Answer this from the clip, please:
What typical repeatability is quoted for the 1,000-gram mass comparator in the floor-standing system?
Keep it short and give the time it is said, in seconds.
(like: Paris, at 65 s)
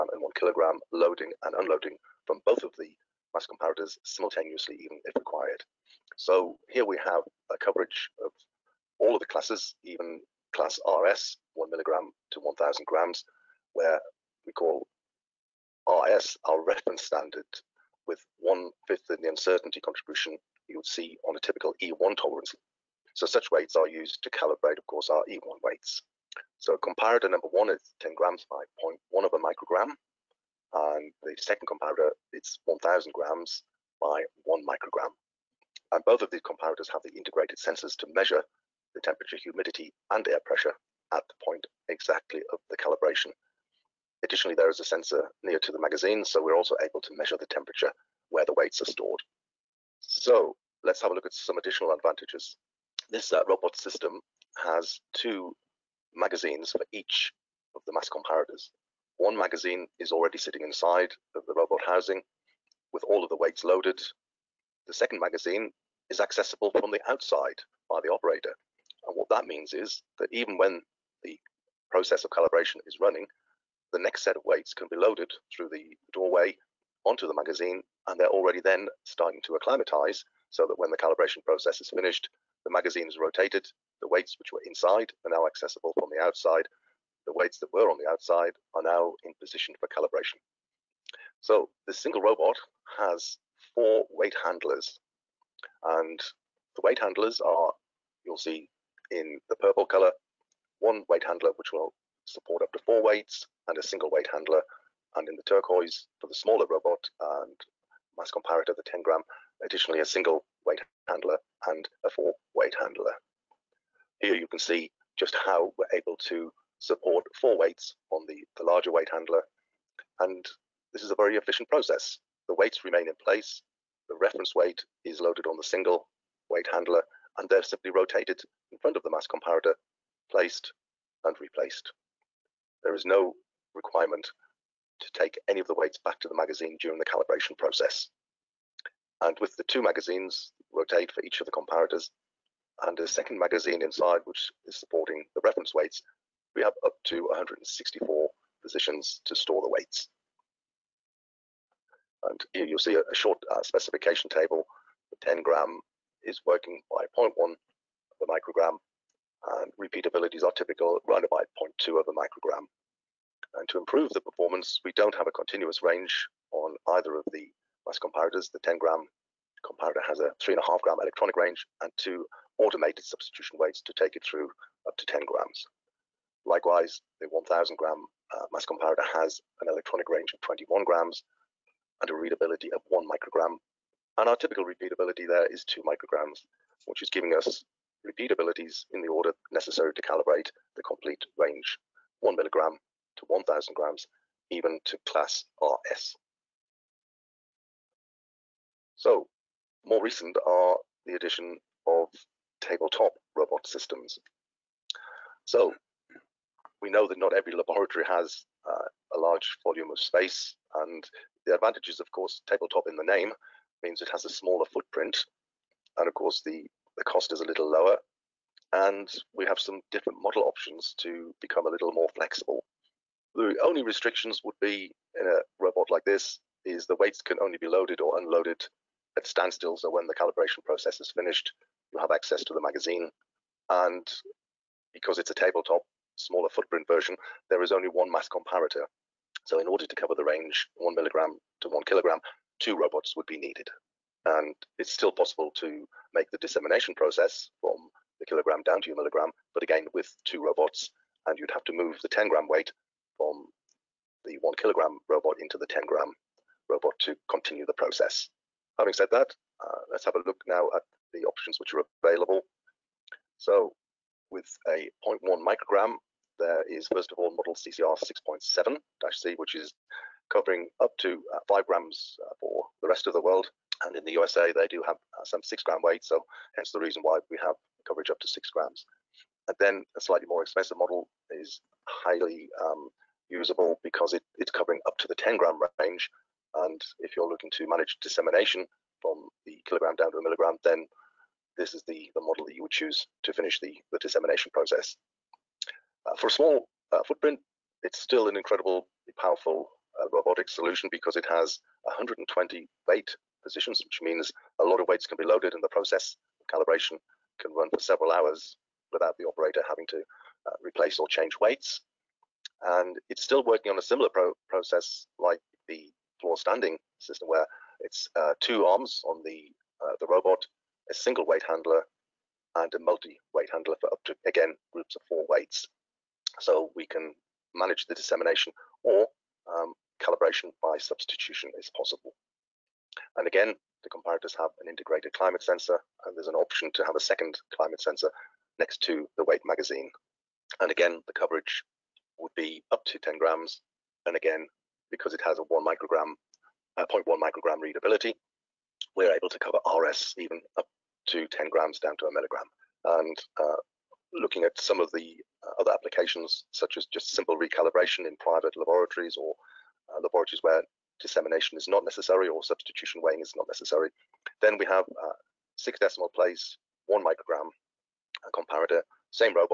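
2 micrograms, at 185 s.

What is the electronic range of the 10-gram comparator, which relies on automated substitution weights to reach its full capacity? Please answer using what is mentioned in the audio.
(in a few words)
3.5 grams.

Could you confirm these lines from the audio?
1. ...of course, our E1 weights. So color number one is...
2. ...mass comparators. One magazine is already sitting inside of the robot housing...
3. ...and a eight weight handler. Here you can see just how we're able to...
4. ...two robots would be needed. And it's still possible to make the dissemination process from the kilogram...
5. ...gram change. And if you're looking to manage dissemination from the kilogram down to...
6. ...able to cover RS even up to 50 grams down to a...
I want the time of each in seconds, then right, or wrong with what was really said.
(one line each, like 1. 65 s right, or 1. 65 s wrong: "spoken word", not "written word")
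1. 24 s wrong: "comparator", not "color"
2. 57 s right
3. 111 s wrong: "four", not "eight"
4. 242 s right
5. 285 s wrong: "range", not "change"
6. 349 s wrong: "10", not "50".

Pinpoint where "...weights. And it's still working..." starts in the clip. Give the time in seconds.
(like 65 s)
311 s.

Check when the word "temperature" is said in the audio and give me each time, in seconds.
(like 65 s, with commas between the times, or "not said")
39 s, 47 s.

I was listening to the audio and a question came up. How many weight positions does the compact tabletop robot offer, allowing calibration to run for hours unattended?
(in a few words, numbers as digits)
120.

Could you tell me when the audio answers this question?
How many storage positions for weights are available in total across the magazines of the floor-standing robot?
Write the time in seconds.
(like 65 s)
147 s.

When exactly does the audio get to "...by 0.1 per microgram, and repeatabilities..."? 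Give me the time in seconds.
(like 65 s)
156 s.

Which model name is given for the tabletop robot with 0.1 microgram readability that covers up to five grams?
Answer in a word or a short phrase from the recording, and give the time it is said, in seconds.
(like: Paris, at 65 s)
CCR 6.7-C, at 267 s.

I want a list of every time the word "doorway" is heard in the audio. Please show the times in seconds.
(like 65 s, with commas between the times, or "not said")
76 s.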